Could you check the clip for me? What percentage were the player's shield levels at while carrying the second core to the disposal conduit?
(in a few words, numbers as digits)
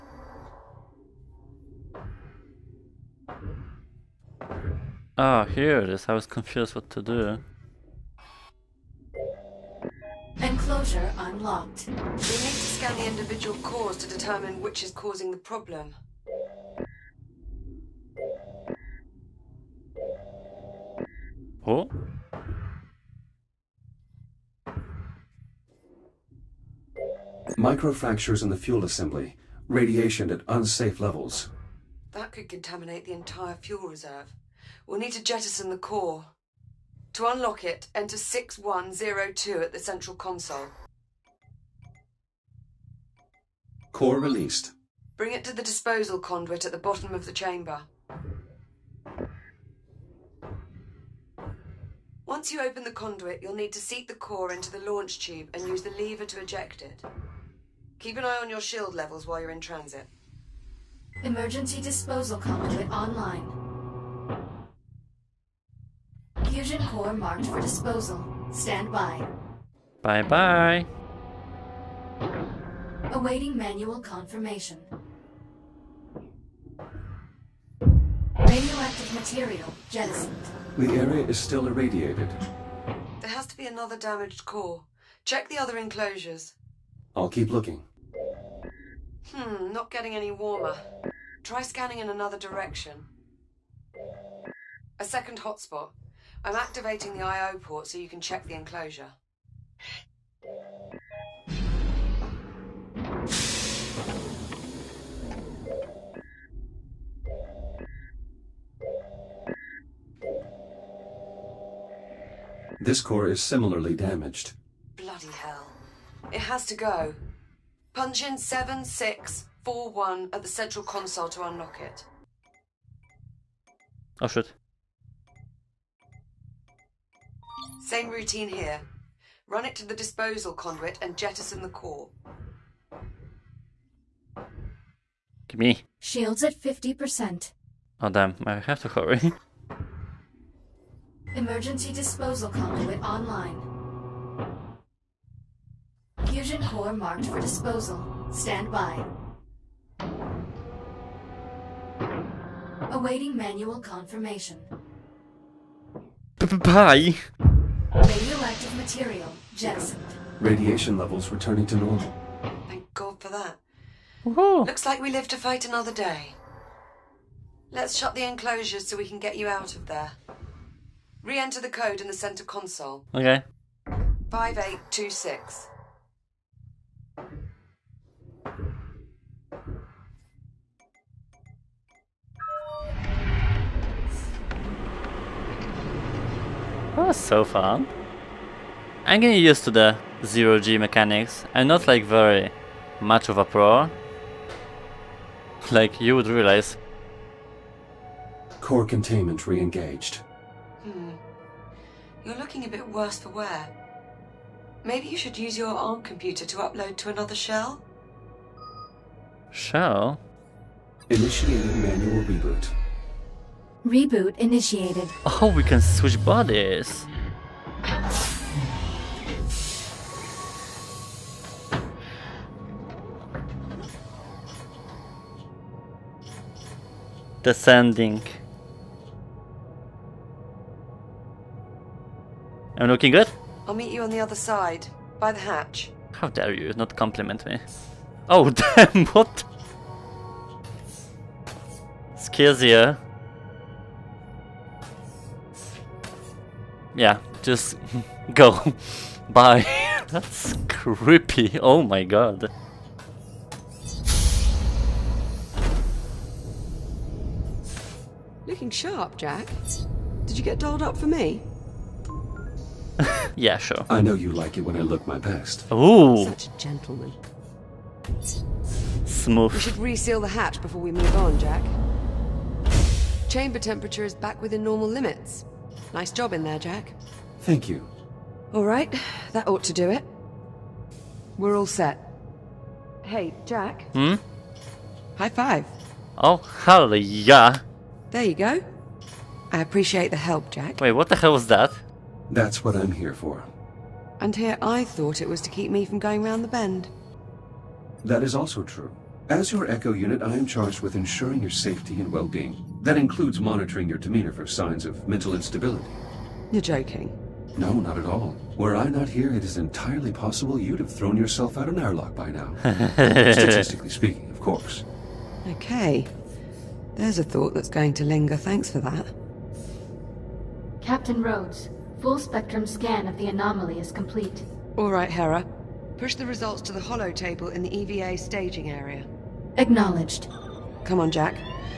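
50%.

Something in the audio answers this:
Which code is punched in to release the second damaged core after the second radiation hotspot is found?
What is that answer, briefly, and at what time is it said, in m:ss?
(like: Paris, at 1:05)
7641, at 1:58.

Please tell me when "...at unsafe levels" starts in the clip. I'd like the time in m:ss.
0:30.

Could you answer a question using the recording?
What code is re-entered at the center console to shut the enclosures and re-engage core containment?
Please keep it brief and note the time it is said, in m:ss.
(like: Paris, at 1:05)
5826, at 2:54.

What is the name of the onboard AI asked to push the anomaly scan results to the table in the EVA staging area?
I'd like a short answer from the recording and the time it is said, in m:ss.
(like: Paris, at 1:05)
Hera, at 5:25.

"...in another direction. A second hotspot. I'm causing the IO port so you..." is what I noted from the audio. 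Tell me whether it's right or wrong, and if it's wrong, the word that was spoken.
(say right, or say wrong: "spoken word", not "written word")
wrong: "activating", not "causing".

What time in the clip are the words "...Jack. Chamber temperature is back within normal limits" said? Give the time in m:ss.
4:31.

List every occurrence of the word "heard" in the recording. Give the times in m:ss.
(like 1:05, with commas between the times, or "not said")
not said.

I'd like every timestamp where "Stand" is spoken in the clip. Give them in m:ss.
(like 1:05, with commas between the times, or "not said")
1:08, 2:28.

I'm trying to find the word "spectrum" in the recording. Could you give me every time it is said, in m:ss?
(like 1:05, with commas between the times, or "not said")
5:22.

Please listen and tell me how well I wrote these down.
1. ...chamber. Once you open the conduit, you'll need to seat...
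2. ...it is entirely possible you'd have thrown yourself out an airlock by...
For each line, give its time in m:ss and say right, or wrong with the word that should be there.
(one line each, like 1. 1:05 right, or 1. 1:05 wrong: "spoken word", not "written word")
1. 0:47 right
2. 5:09 right.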